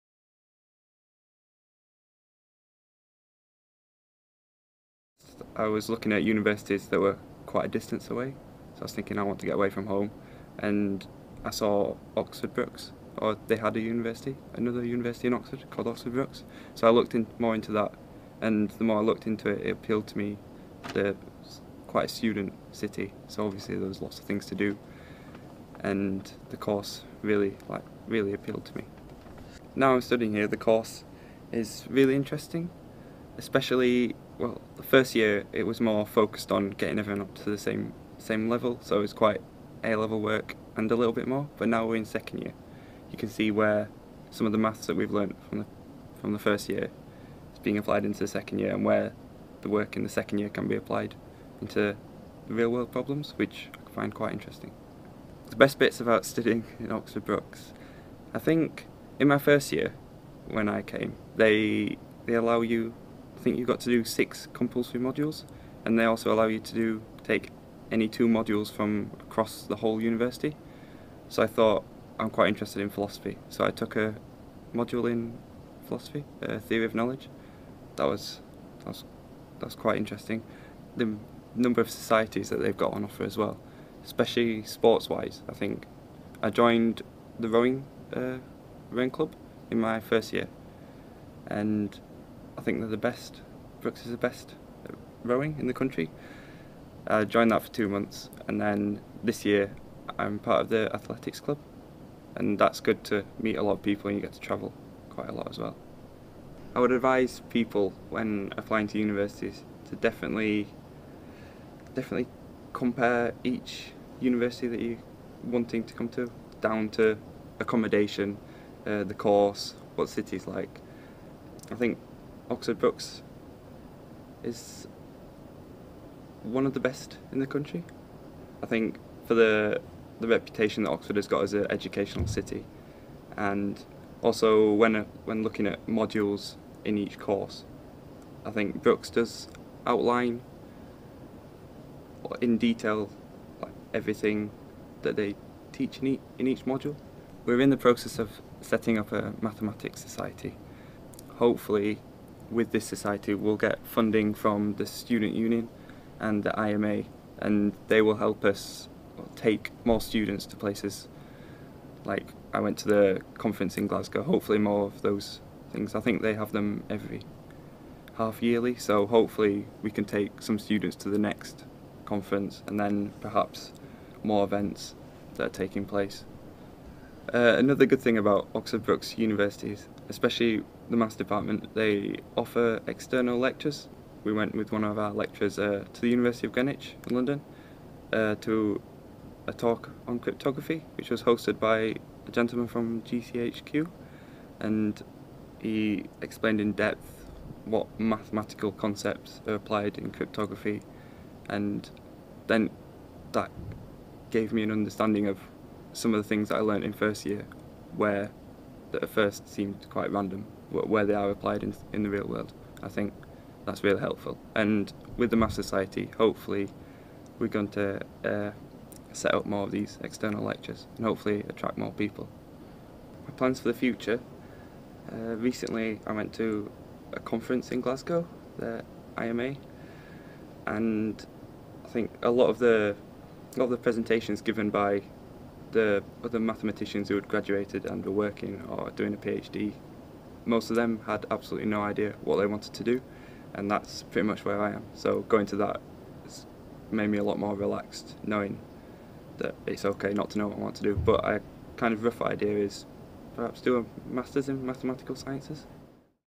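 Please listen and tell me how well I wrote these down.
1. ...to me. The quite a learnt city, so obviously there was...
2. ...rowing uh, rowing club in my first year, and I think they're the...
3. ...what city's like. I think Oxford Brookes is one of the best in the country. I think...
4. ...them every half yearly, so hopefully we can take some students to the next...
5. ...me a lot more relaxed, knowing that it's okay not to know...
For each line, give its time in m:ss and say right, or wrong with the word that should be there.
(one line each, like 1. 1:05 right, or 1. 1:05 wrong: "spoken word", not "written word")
1. 0:20 wrong: "student", not "learnt"
2. 1:27 right
3. 1:59 right
4. 2:46 right
5. 4:07 right.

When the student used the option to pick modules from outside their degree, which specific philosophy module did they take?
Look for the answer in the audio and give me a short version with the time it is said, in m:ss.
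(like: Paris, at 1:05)
Theory of knowledge, at 1:16.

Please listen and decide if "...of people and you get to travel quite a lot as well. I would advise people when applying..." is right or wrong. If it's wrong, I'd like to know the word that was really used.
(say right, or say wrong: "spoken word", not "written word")
right.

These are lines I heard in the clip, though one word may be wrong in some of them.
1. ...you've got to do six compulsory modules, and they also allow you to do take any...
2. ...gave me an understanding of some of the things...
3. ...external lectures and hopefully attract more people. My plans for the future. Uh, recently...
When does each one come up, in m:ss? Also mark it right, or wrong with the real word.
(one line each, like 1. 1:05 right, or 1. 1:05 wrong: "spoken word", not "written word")
1. 1:03 right
2. 3:24 right
3. 3:40 right.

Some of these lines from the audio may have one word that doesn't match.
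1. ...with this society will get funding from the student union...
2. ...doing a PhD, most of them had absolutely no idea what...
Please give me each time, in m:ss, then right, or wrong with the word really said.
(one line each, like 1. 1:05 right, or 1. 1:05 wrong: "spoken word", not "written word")
1. 2:32 right
2. 3:58 right.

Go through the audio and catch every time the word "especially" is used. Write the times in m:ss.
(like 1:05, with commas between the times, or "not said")
0:33, 1:24, 3:00.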